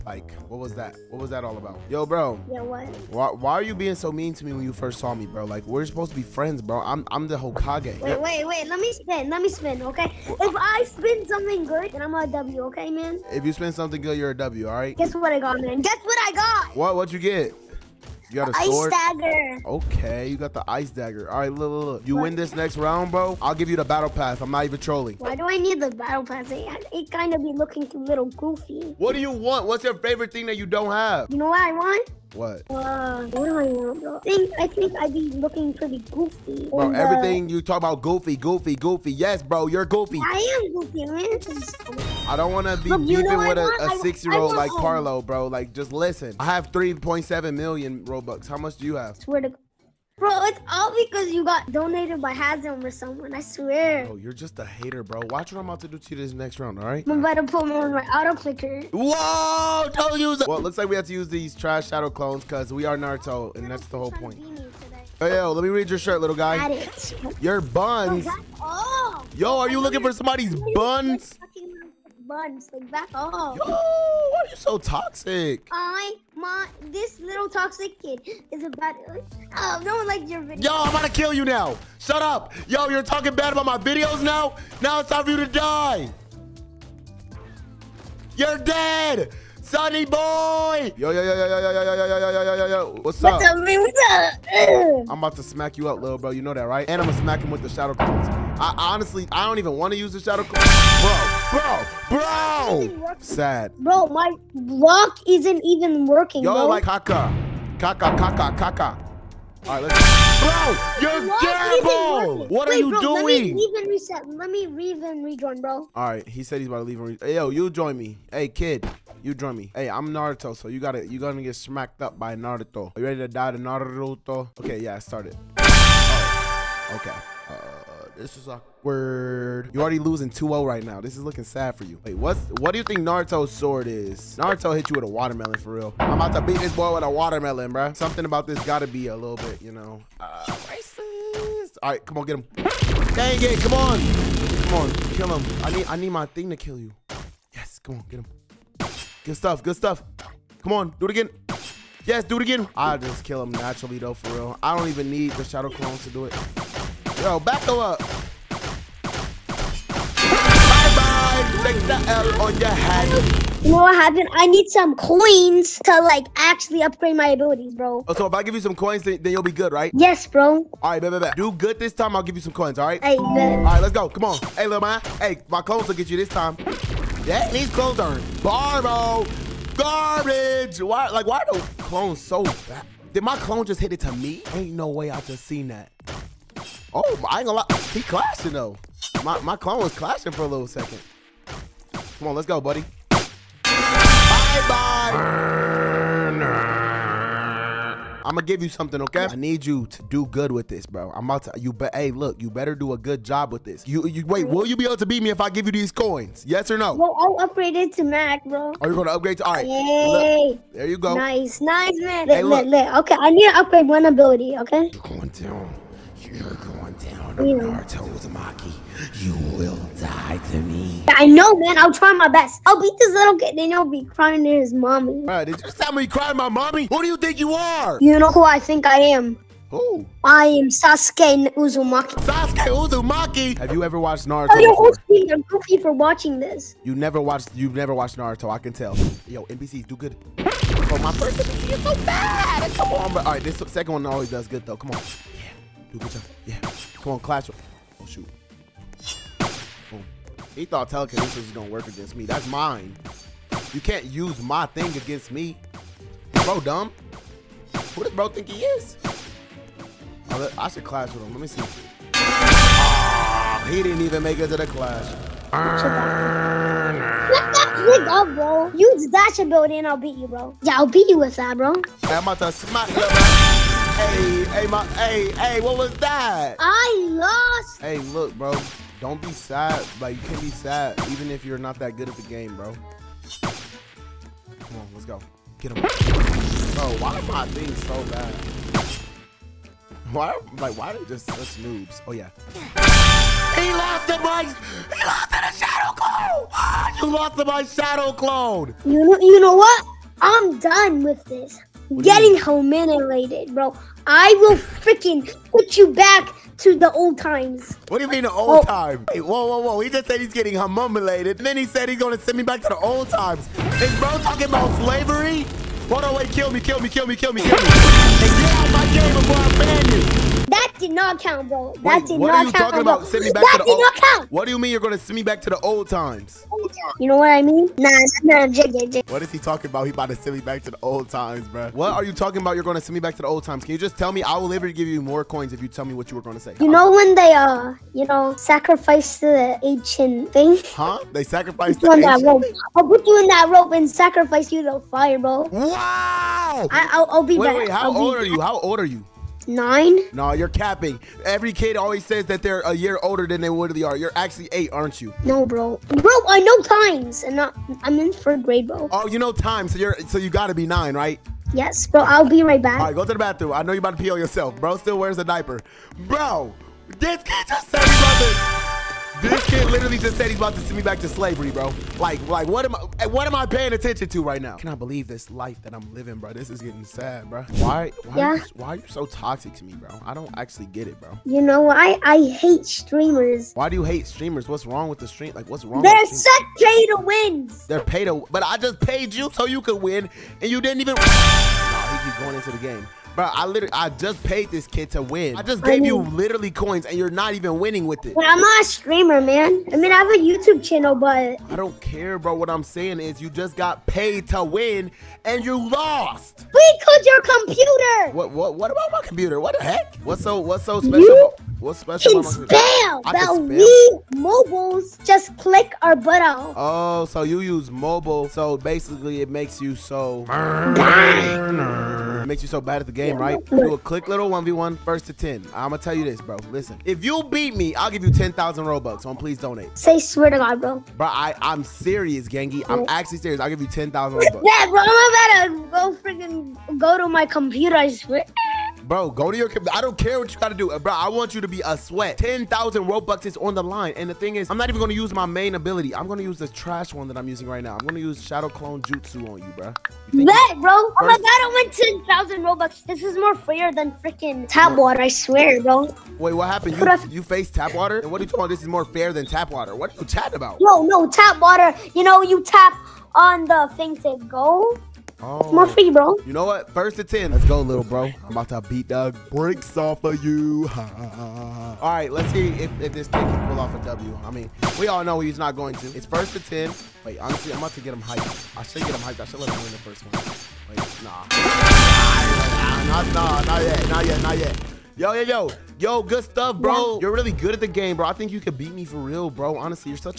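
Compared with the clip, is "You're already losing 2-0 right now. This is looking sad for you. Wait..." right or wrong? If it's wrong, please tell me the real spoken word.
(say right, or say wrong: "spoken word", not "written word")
right.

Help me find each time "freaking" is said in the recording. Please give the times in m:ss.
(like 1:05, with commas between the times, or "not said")
5:04, 7:16, 7:33.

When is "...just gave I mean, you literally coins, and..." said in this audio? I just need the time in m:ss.
6:35.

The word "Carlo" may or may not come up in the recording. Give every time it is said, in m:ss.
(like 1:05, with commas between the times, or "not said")
0:44.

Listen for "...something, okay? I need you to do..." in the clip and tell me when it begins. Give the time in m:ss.
3:18.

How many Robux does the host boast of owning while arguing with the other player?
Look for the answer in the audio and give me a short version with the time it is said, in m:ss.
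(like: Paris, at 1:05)
3.7 million, at 0:46.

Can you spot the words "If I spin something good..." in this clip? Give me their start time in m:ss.
0:10.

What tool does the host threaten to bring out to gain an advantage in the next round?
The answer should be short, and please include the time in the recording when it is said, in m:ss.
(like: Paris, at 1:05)
Auto clicker, at 0:58.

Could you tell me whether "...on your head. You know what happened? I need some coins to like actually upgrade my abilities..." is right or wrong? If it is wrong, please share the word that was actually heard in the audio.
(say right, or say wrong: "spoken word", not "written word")
right.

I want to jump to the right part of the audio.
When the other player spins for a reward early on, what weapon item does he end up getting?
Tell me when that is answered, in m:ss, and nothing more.
0:20.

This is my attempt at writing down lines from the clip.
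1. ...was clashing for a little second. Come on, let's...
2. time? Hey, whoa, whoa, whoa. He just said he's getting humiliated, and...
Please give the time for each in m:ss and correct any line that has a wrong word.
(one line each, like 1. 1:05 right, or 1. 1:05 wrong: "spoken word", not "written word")
1. 3:09 right
2. 5:08 right.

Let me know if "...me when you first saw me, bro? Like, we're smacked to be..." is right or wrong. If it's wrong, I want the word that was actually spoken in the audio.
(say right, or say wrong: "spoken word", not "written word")
wrong: "supposed", not "smacked".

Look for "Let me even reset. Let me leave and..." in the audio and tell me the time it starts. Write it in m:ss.
1:53.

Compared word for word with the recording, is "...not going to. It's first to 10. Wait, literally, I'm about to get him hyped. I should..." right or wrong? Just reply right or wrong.
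wrong.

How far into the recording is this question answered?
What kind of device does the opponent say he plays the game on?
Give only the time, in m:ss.
6:57.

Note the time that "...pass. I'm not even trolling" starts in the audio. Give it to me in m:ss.
0:24.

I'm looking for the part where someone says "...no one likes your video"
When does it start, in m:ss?
1:19.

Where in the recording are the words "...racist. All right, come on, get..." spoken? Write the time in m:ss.
2:20.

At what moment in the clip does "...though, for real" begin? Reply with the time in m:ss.
2:33.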